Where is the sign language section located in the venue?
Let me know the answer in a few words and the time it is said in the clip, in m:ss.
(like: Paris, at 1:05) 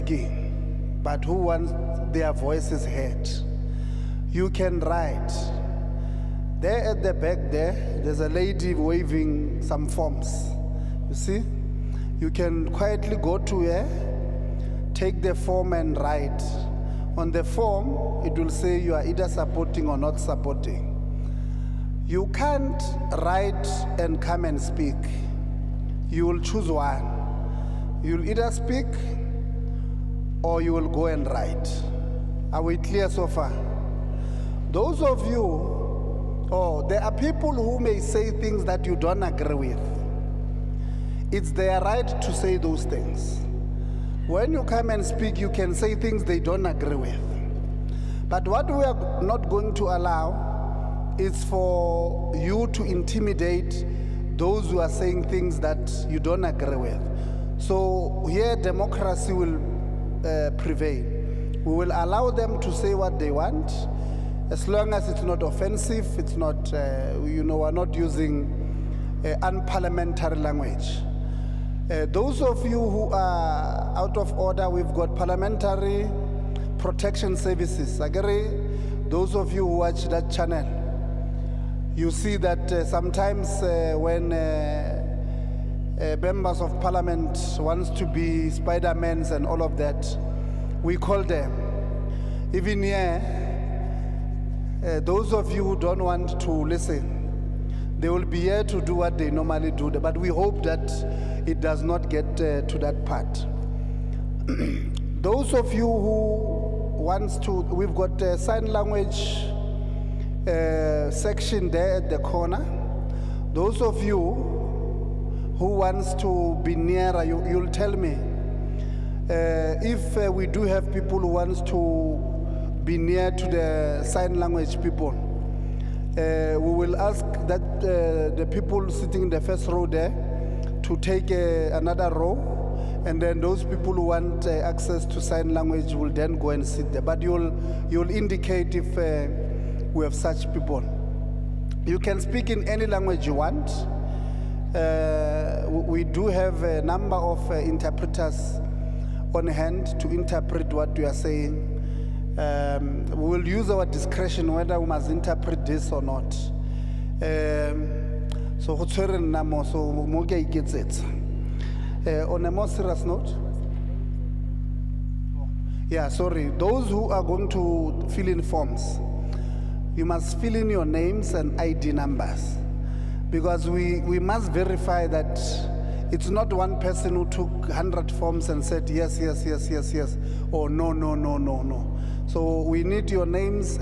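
At the corner, at 1:51.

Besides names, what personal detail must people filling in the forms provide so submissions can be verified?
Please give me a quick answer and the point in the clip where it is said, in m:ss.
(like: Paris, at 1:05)
ID numbers, at 2:51.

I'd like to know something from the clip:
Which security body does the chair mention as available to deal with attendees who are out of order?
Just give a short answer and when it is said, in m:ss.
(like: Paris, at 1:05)
Parliamentary protection services, at 1:15.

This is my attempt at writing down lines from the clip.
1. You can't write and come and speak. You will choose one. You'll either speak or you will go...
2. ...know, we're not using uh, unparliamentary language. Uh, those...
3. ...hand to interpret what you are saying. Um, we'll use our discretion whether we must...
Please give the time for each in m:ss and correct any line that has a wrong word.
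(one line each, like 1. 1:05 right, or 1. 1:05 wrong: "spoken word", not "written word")
1. 0:22 right
2. 1:07 right
3. 2:29 right.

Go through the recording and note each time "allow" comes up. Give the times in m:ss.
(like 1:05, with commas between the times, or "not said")
0:49, 1:01.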